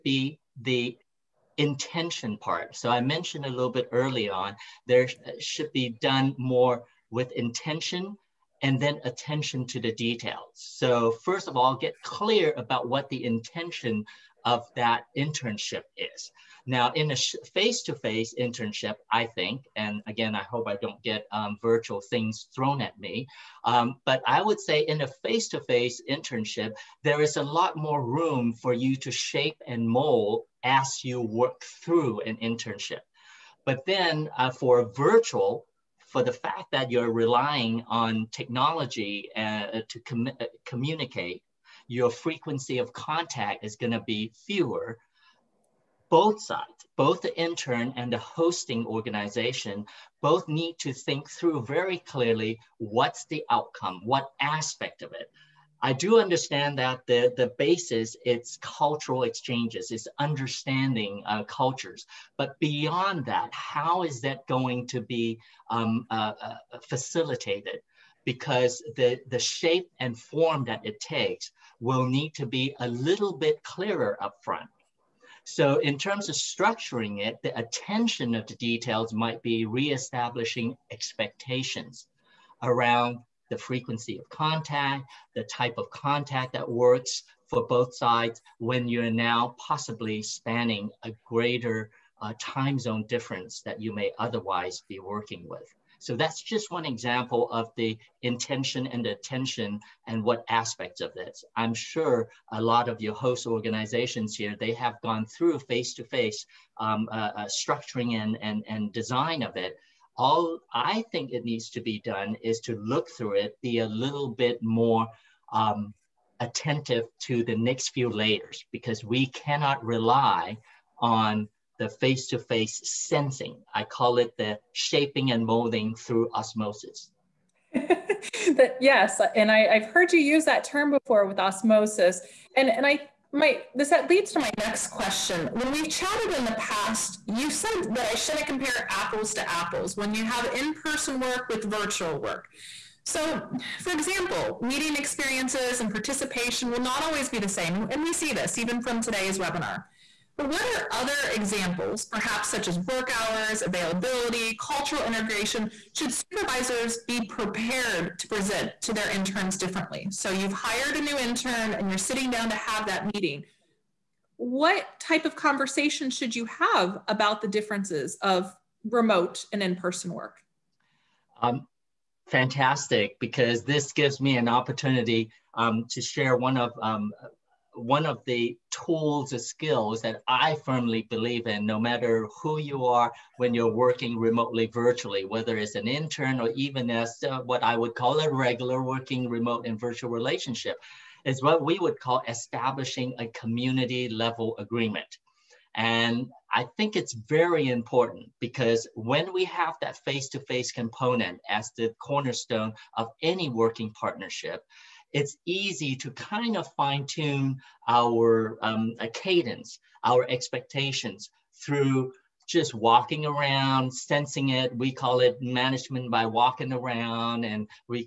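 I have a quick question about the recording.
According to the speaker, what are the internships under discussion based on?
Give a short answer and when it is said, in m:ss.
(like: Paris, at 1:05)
cultural exchanges, at 0:58.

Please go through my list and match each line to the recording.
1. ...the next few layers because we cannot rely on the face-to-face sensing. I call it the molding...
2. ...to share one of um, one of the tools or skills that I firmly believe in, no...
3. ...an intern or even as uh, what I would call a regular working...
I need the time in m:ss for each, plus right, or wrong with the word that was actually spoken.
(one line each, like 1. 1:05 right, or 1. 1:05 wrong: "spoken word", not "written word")
1. 1:57 wrong: "shaping", not "molding"
2. 2:55 right
3. 3:05 right.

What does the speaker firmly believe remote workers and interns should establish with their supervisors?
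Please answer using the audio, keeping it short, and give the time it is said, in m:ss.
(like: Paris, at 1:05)
community level agreement, at 3:13.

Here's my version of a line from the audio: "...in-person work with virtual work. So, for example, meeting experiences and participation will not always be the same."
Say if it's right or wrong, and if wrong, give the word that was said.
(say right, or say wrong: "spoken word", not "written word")
right.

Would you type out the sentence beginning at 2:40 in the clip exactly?
So you've hired a new intern and you're sitting down to have that meeting.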